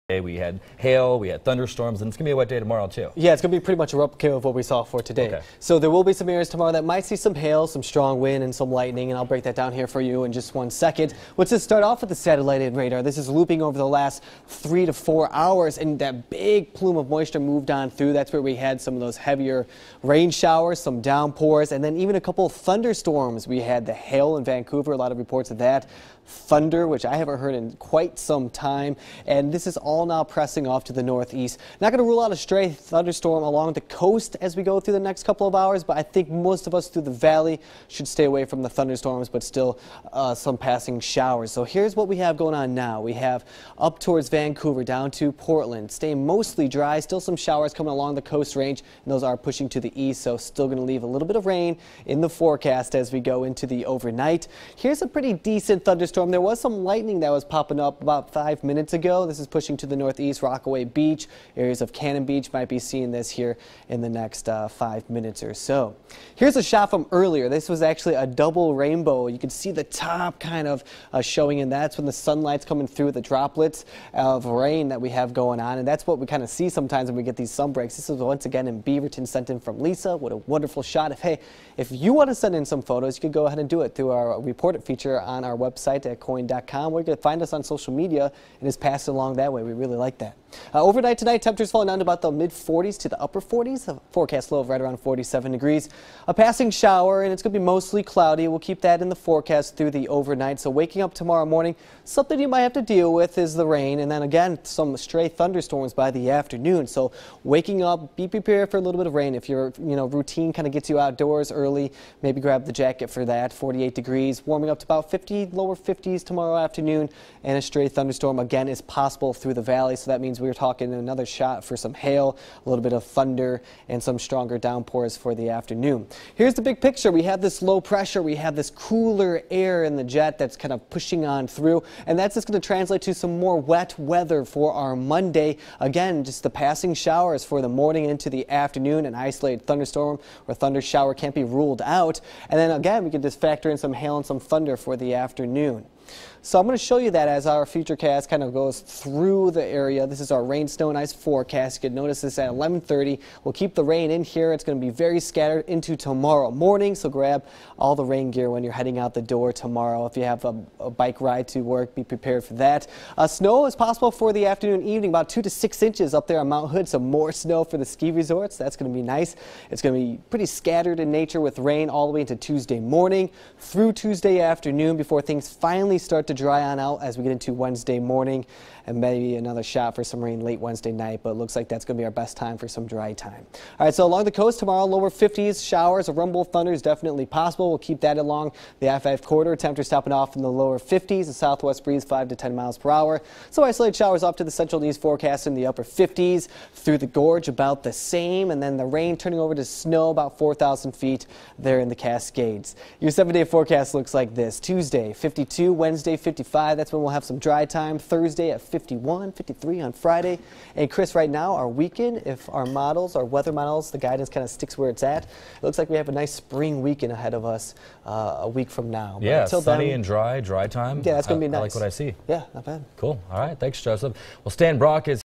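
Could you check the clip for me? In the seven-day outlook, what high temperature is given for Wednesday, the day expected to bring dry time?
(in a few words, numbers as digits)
55.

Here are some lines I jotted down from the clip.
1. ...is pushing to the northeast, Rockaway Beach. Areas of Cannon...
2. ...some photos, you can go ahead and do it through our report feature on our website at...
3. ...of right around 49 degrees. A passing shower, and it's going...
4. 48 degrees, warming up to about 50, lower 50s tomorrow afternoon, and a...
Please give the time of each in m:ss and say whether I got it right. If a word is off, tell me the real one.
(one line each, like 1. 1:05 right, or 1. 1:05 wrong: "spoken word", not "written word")
1. 0:59 right
2. 1:22 right
3. 1:34 wrong: "47", not "49"
4. 1:53 right.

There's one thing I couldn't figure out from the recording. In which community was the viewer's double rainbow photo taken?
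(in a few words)
Beaverton.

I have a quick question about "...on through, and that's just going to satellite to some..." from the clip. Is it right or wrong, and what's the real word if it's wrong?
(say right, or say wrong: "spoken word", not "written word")
wrong: "translate", not "satellite".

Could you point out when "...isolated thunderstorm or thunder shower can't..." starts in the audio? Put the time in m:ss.
2:19.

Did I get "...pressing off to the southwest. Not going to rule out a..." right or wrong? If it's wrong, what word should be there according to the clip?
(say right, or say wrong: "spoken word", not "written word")
wrong: "northeast", not "southwest".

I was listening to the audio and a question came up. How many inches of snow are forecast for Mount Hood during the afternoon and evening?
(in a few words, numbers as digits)
2 to 6 inches.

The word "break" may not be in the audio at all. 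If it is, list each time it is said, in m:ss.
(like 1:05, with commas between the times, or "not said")
0:09, 1:17.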